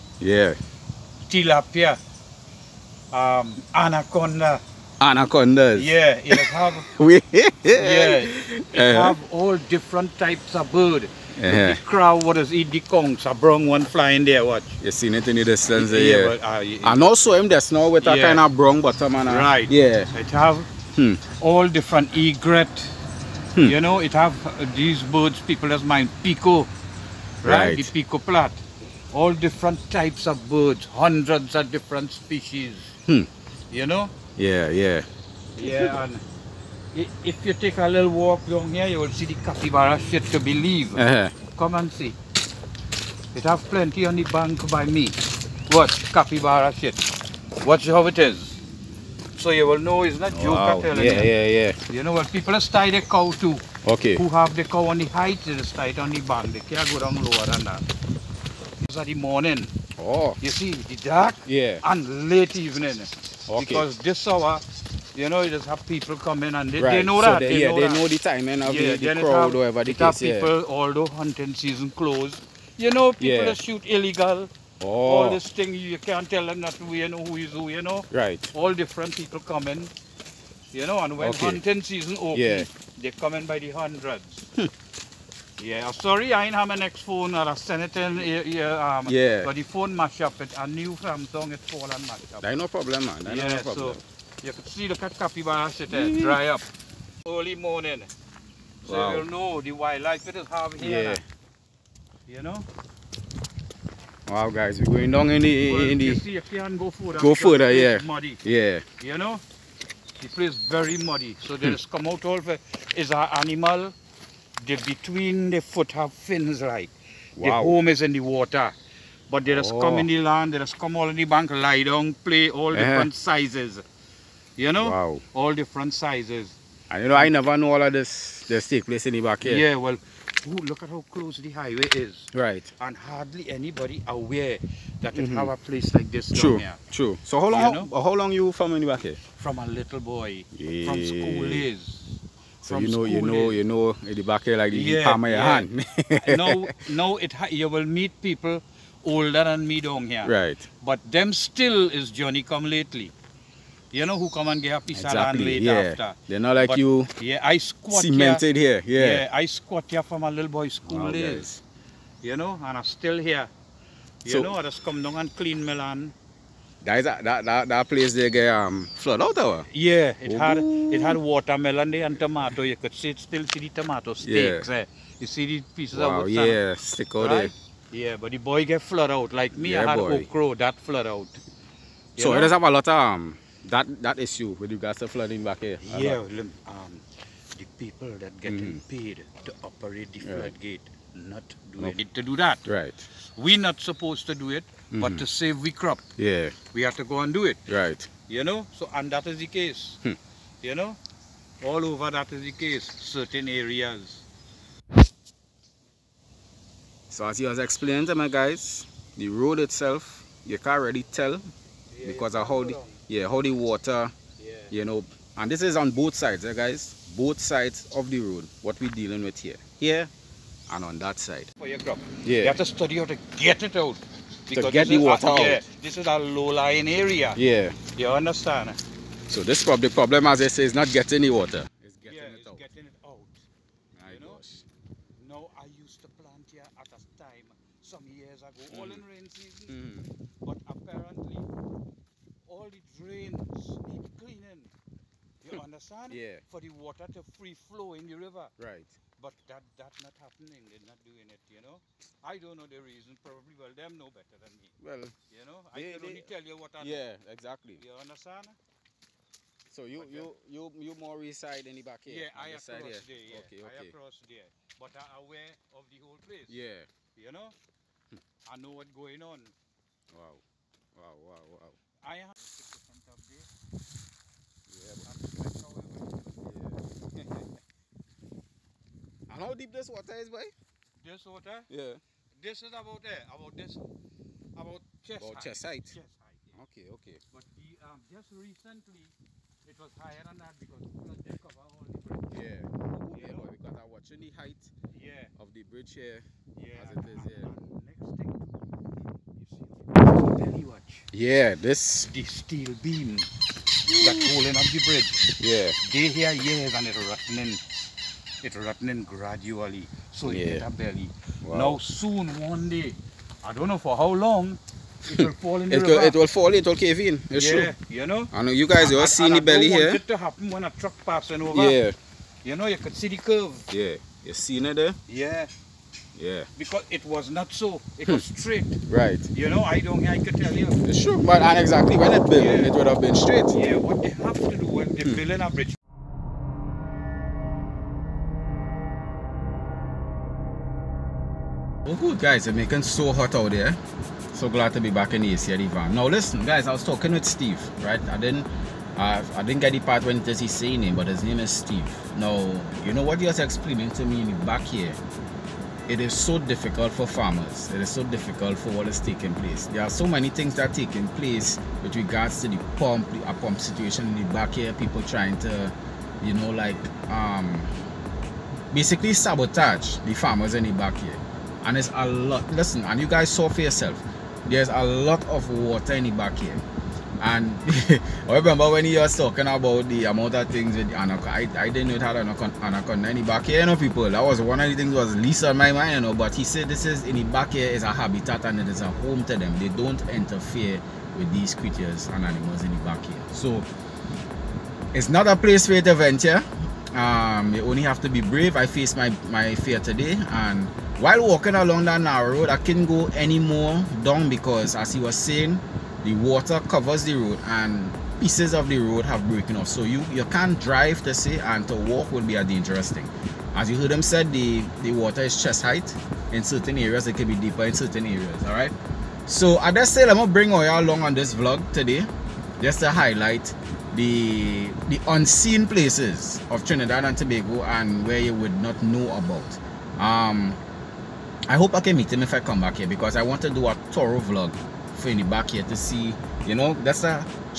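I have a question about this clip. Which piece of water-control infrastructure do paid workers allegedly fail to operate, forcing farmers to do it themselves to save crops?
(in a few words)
Floodgate.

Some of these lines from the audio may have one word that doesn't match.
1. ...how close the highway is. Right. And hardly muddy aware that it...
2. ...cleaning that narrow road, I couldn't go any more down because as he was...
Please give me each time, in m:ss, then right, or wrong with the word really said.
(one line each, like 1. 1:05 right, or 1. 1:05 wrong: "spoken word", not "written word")
1. 2:10 wrong: "anybody", not "muddy"
2. 6:41 wrong: "along", not "cleaning".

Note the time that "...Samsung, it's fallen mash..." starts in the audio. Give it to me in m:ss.
1:30.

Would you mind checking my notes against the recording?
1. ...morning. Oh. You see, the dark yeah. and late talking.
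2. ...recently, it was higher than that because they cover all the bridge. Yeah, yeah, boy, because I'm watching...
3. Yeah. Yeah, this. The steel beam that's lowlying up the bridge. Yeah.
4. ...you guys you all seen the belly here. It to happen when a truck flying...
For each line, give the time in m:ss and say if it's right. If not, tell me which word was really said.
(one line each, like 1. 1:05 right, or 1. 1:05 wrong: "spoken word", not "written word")
1. 0:59 wrong: "evening", not "talking"
2. 4:48 right
3. 4:57 wrong: "holding", not "lowlying"
4. 5:18 wrong: "passing", not "flying".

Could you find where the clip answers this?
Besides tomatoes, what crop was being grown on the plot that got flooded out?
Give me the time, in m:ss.
2:51.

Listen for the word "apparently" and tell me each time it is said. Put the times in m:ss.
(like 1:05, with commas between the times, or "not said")
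4:00.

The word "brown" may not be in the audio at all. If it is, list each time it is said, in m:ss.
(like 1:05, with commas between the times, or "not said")
0:13, 0:18.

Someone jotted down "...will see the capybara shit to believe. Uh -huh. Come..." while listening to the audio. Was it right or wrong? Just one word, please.
right.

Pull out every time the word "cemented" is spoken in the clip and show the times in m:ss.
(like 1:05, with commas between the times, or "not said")
2:38.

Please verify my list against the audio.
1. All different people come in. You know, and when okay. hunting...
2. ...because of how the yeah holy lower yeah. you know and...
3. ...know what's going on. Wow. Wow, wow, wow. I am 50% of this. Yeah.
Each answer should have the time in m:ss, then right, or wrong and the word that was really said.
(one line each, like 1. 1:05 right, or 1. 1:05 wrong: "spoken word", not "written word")
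1. 1:18 right
2. 3:32 wrong: "water", not "lower"
3. 4:28 right.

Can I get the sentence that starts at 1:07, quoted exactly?
know the timing of yeah, the, the crowd, or whatever the case.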